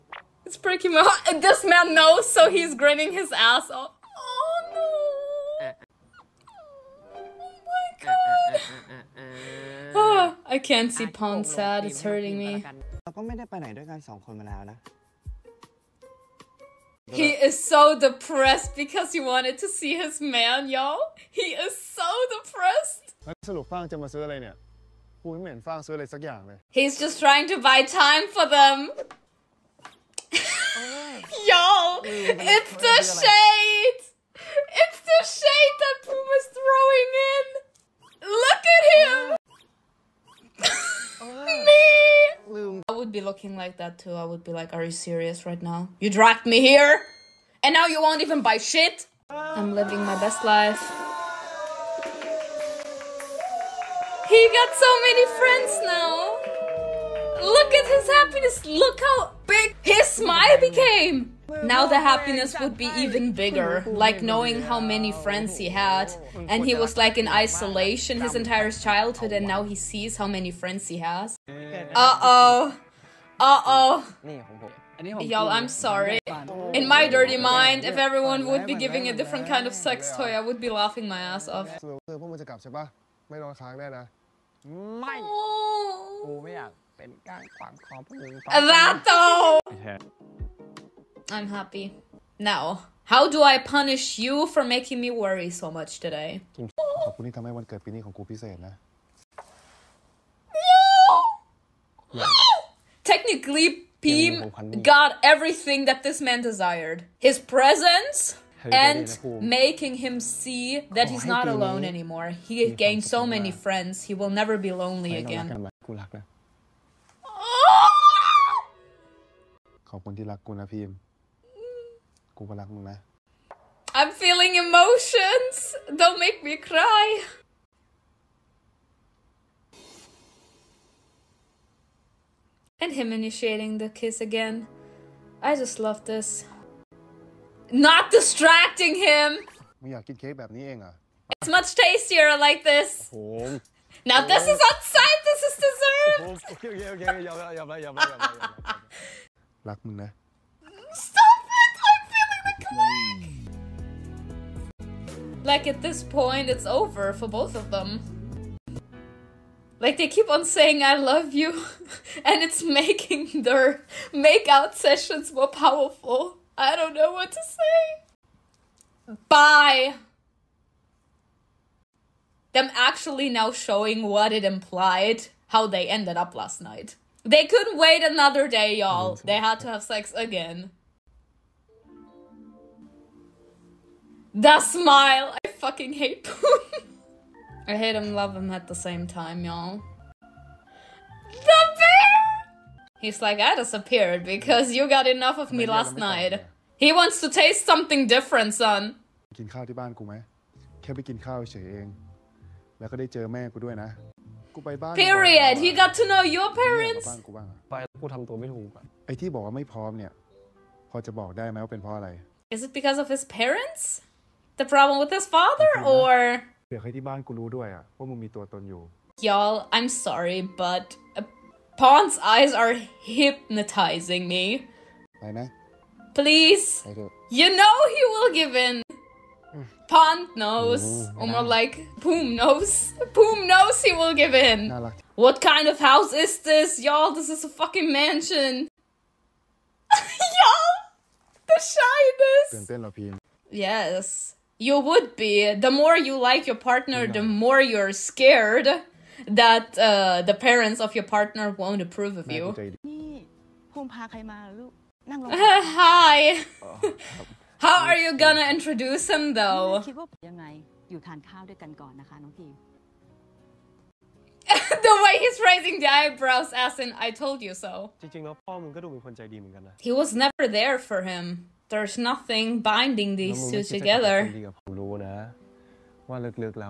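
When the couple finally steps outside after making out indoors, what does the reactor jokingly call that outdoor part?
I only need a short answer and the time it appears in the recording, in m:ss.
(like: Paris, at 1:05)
dessert, at 2:25.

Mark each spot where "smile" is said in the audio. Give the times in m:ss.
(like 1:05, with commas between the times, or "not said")
1:00, 3:04.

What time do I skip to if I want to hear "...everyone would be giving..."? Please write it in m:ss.
1:17.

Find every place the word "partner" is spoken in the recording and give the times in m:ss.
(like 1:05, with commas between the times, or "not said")
4:06, 4:11.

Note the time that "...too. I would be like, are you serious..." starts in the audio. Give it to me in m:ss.
0:43.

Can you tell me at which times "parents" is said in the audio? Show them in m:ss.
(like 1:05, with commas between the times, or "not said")
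3:26, 3:33, 4:10.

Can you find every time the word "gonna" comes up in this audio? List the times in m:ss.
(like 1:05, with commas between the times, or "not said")
4:18.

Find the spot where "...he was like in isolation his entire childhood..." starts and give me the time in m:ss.
1:06.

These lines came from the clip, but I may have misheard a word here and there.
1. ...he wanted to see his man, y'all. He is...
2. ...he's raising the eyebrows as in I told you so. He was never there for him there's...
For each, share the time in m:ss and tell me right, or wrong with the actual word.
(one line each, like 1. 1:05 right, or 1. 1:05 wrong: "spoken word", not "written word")
1. 0:19 right
2. 4:25 right.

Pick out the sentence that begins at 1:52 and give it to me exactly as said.
He gained so many friends, he will never be lonely again.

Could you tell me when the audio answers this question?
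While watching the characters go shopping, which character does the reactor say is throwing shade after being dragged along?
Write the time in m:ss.
0:36.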